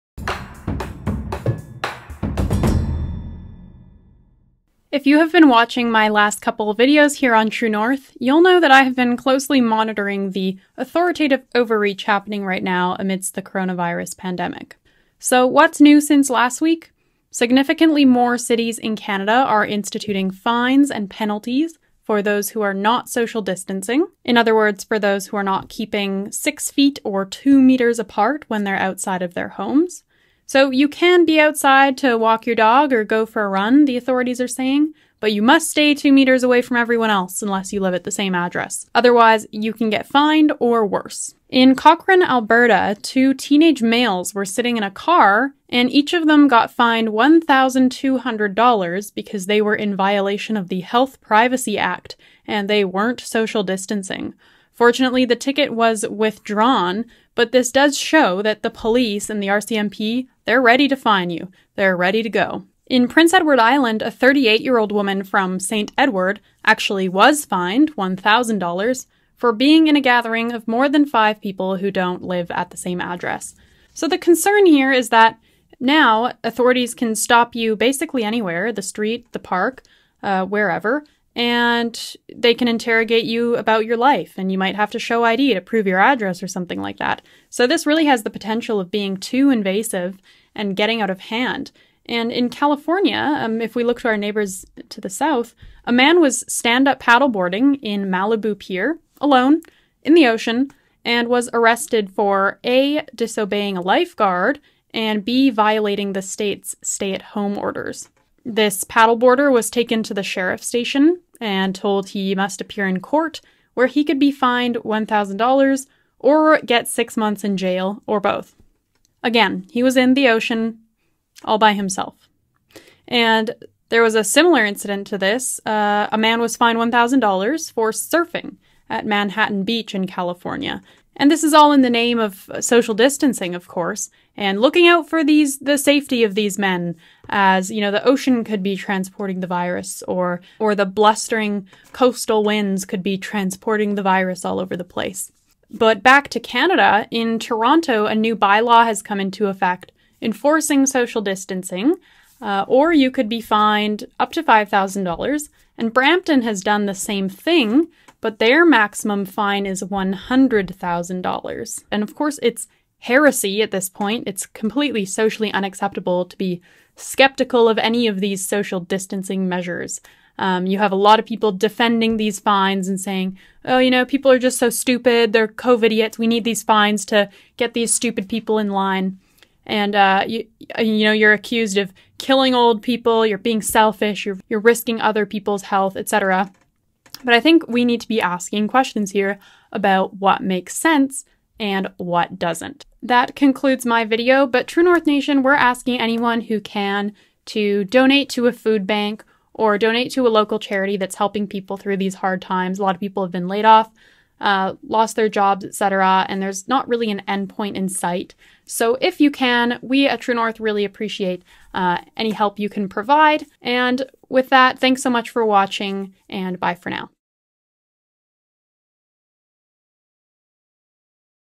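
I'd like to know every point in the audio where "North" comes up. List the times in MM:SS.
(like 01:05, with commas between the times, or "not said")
00:07, 03:14, 03:30.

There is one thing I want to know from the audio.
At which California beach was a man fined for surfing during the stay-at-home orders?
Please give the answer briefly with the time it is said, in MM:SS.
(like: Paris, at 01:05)
Manhattan Beach, at 02:09.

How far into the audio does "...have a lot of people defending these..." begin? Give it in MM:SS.
02:50.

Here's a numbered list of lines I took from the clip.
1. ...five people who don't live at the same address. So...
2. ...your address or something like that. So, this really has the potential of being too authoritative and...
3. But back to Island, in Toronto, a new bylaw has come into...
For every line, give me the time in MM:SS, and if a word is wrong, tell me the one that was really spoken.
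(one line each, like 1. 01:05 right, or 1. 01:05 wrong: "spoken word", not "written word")
1. 01:11 right
2. 01:25 wrong: "invasive", not "authoritative"
3. 02:25 wrong: "Canada", not "Island".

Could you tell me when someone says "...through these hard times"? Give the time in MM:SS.
03:21.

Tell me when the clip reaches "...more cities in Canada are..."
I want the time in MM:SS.
00:18.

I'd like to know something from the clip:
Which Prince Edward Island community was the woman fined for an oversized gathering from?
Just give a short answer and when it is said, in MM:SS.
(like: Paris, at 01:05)
St. Edward, at 01:05.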